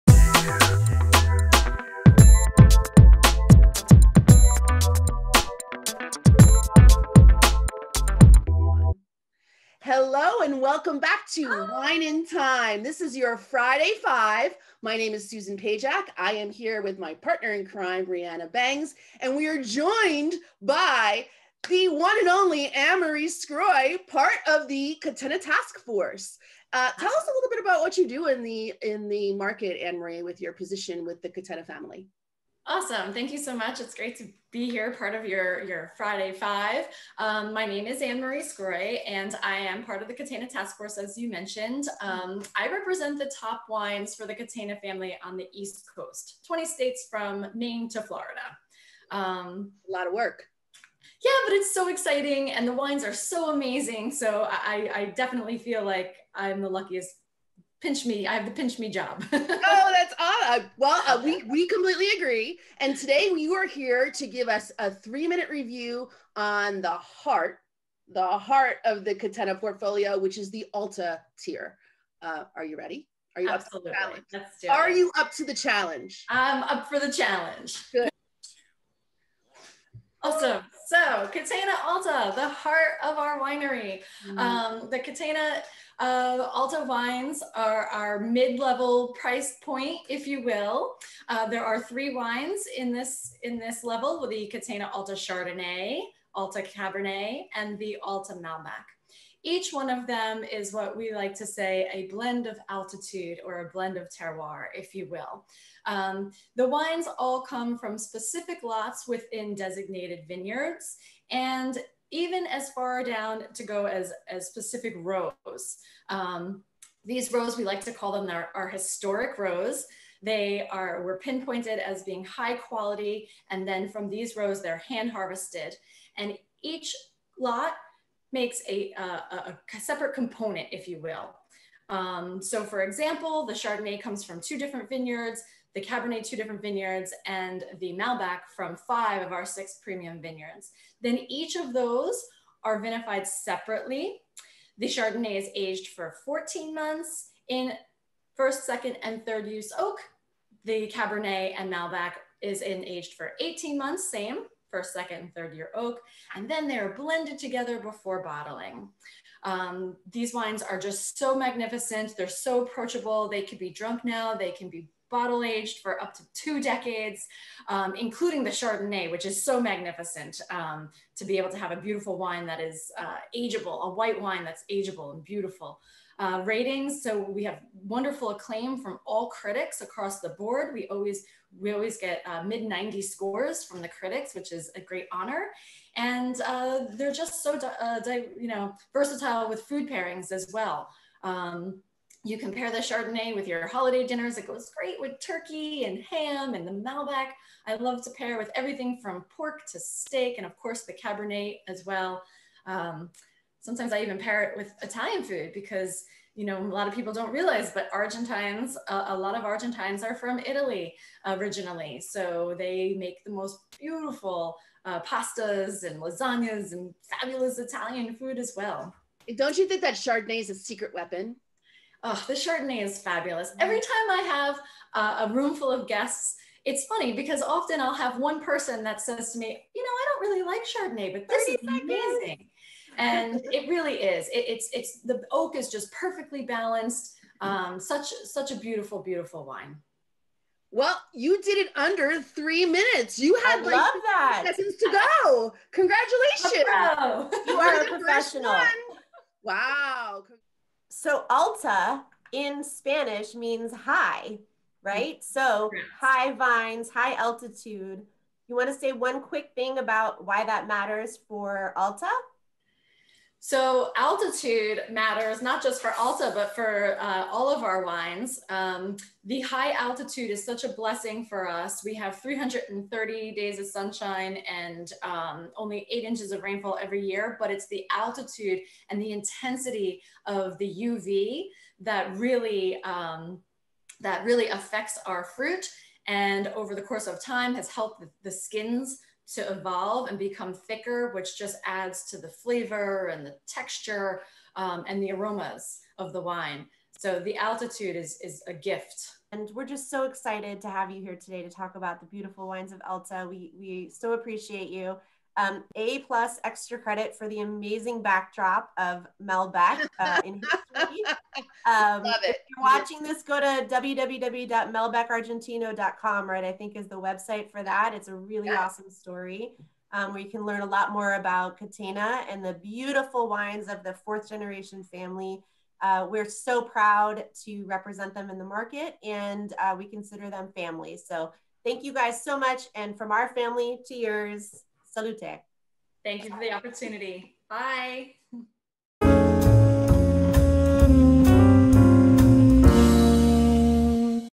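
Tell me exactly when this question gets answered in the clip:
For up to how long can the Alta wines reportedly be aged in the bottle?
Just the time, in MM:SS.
02:46.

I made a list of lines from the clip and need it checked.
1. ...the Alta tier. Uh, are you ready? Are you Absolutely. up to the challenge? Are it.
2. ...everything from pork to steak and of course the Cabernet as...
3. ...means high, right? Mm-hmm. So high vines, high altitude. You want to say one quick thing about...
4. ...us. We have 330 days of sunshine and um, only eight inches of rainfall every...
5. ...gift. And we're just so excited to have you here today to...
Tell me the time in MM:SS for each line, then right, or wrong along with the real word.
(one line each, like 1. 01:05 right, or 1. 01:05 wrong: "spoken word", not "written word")
1. 01:10 right
2. 03:18 right
3. 04:13 right
4. 04:31 right
5. 04:58 right.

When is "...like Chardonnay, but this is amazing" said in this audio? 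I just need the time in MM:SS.
03:50.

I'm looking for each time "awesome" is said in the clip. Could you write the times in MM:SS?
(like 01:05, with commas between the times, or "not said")
00:32, 01:00, 01:20, 05:18.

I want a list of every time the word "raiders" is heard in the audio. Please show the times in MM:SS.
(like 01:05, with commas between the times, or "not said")
not said.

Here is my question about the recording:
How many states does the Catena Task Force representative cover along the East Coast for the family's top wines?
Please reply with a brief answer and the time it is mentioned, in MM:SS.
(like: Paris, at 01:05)
20, at 00:46.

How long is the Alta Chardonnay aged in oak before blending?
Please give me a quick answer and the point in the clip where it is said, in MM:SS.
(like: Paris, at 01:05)
14 months, at 02:26.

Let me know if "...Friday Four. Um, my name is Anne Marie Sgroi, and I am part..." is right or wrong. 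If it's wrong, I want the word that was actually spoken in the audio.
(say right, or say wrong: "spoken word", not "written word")
wrong: "Five", not "Four".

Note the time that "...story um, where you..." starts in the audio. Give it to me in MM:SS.
05:18.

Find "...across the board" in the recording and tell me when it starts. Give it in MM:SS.
02:59.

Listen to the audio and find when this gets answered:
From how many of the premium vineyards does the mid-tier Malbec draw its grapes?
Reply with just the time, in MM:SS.
02:18.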